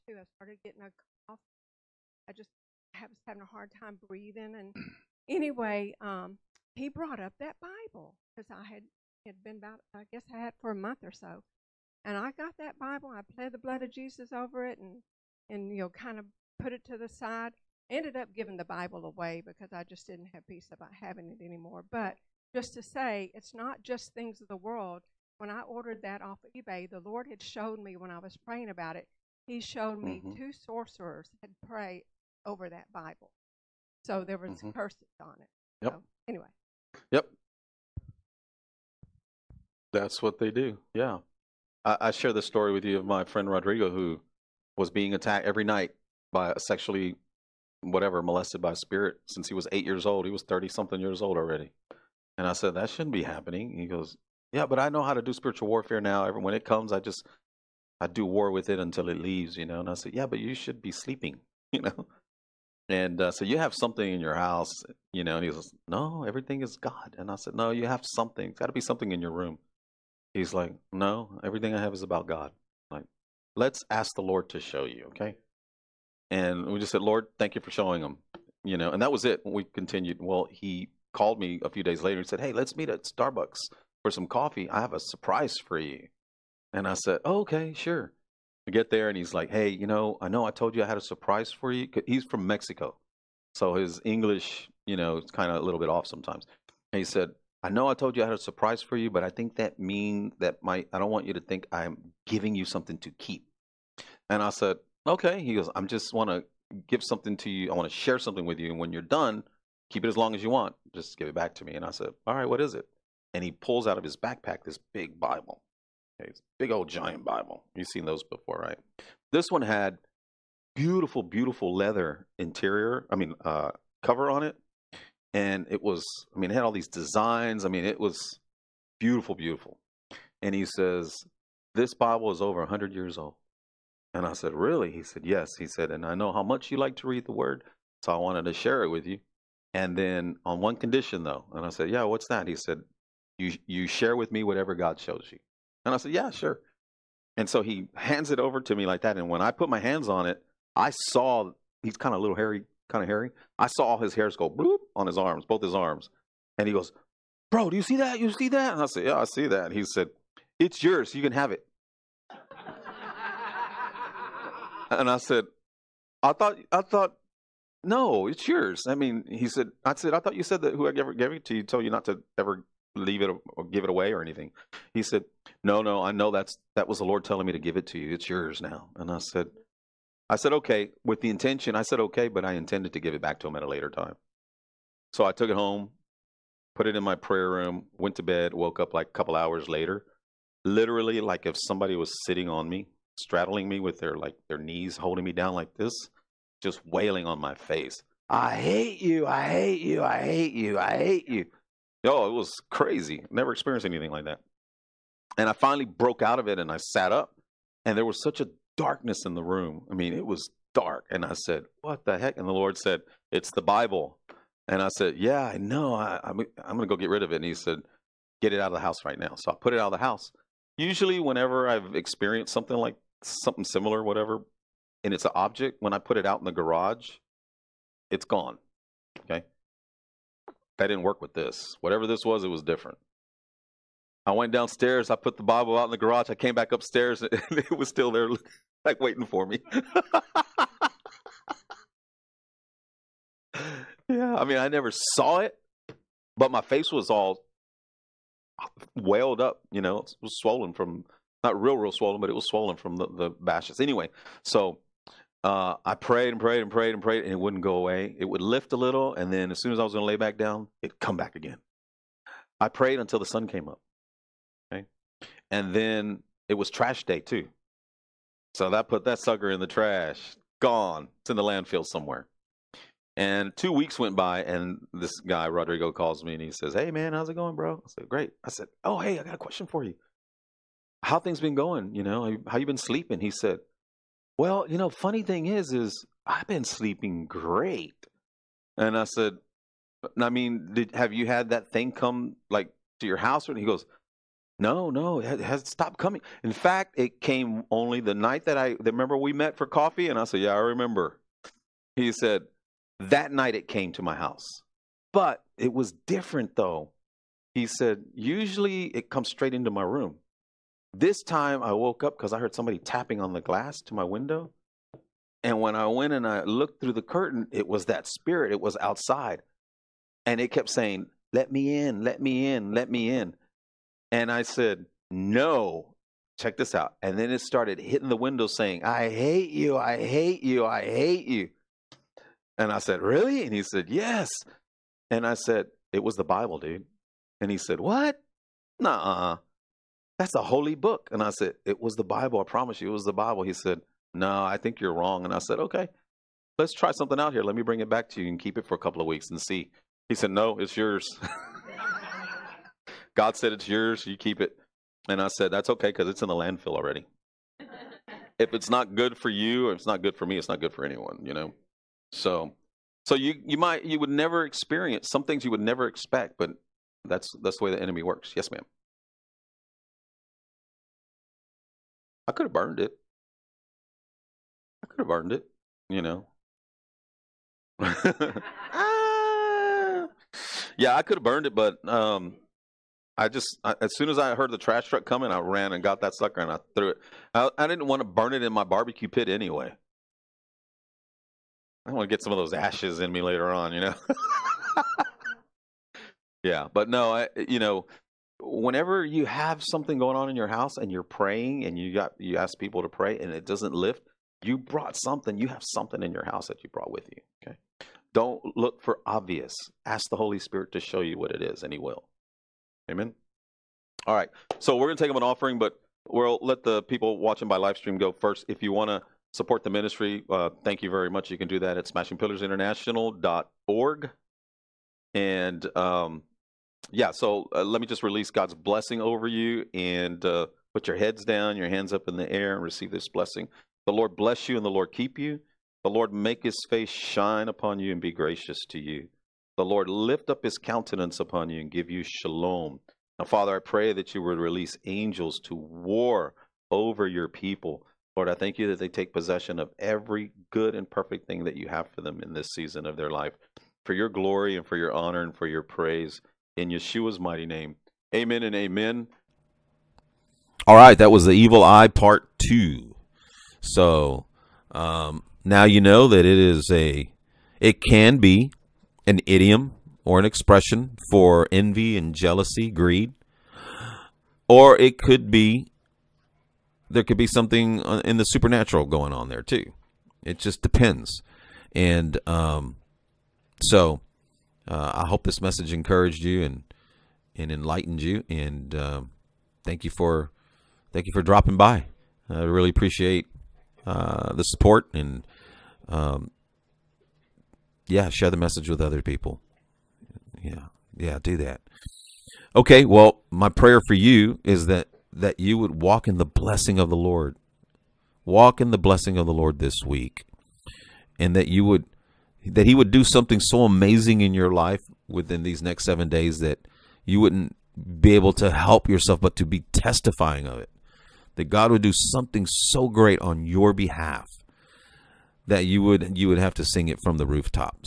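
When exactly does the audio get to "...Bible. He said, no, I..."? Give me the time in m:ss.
5:43.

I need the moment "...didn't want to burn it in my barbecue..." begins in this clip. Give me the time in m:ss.
6:27.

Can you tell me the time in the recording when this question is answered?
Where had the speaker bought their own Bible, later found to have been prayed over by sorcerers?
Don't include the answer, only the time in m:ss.
0:26.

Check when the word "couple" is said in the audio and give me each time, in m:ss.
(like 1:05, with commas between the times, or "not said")
3:09, 5:48.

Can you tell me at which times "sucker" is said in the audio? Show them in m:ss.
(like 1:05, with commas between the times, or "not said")
4:29, 6:26.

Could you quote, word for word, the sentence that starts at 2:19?
And then on one condition though, and I said, yeah, what's that?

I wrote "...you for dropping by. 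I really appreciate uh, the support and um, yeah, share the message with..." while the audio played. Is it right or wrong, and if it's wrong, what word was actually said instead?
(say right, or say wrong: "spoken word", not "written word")
right.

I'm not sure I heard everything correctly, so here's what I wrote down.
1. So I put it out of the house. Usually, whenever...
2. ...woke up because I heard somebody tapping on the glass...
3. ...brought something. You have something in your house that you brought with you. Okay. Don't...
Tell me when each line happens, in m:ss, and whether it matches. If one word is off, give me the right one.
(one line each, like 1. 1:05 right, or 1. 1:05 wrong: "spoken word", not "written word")
1. 3:39 right
2. 5:11 right
3. 6:44 right.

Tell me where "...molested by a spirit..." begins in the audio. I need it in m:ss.
0:48.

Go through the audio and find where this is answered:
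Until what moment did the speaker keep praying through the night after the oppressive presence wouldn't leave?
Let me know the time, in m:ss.
4:23.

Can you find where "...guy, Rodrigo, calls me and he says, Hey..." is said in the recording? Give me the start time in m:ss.
4:35.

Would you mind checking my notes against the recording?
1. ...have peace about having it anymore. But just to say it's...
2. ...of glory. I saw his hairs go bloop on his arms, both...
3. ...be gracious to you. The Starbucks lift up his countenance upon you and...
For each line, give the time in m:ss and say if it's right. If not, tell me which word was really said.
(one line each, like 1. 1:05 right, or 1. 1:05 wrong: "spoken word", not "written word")
1. 0:20 right
2. 2:33 wrong: "hairy", not "glory"
3. 7:18 wrong: "Lord", not "Starbucks".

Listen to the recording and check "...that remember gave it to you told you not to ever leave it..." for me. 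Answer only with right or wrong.
wrong.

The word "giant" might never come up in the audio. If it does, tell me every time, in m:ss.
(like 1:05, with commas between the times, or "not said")
1:56.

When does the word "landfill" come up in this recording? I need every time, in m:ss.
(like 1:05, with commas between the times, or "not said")
4:31, 5:56.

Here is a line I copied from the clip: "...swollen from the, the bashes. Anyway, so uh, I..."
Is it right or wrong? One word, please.
right.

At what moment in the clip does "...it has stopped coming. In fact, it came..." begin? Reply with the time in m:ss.
4:55.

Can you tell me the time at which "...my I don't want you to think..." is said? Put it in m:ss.
1:40.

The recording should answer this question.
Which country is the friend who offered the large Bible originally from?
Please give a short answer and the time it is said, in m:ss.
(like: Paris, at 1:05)
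Mexico, at 1:32.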